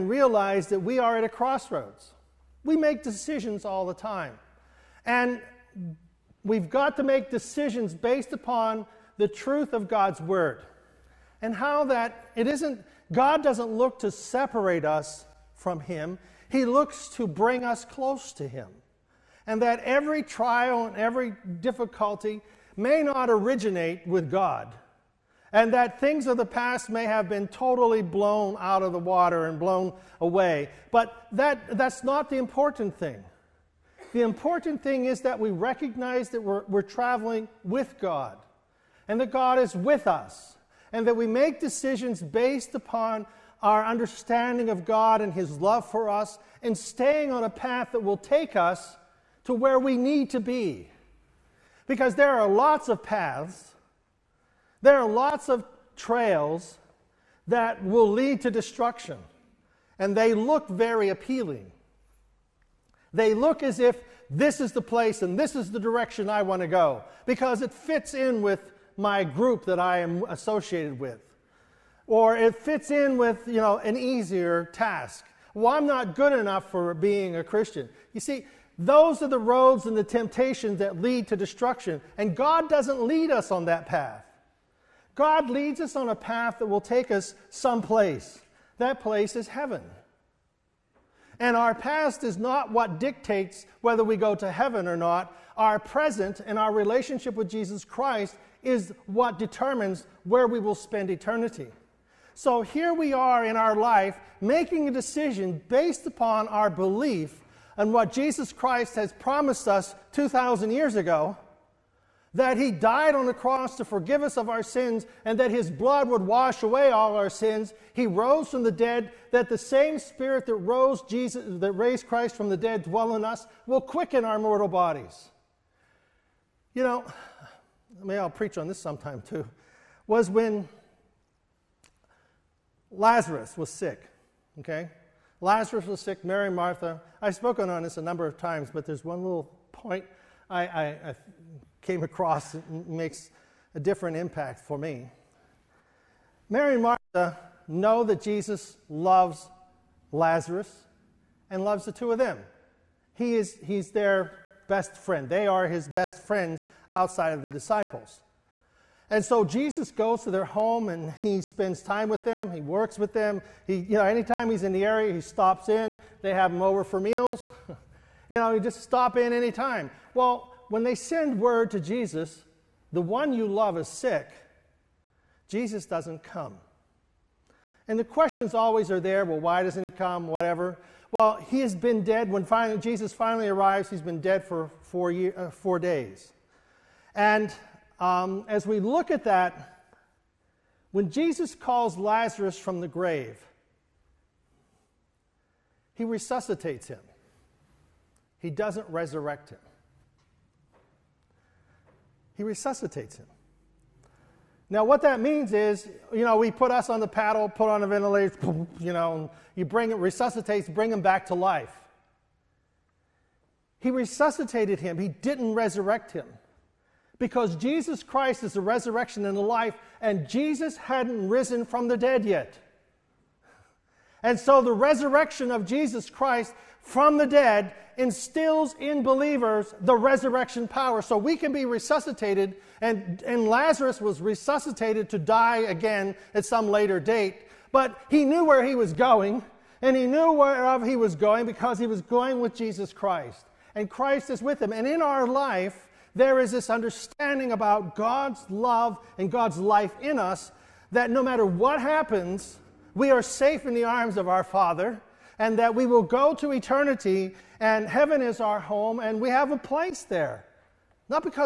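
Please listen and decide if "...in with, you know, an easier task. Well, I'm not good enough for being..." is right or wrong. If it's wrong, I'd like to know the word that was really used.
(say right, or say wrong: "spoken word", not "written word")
right.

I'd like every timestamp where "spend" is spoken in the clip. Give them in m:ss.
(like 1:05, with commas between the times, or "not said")
1:40, 2:41.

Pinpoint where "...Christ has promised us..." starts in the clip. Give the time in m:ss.
1:48.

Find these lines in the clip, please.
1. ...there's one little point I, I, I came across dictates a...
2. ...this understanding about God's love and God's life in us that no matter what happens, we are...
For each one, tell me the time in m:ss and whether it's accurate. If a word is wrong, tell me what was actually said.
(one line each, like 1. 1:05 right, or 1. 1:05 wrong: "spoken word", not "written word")
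1. 2:18 wrong: "makes", not "dictates"
2. 4:06 right.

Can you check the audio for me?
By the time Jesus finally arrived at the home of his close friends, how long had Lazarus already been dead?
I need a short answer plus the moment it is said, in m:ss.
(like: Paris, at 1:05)
4 days, at 3:05.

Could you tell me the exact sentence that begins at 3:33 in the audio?
He resuscitated him, he didn't resurrect him.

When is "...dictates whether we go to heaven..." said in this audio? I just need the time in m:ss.
1:33.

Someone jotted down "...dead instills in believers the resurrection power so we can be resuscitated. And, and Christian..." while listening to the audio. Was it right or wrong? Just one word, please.
wrong.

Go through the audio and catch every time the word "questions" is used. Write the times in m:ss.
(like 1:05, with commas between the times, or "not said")
2:58.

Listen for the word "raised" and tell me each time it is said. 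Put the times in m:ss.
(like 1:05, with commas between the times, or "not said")
2:01.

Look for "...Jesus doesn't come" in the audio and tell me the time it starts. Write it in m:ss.
2:55.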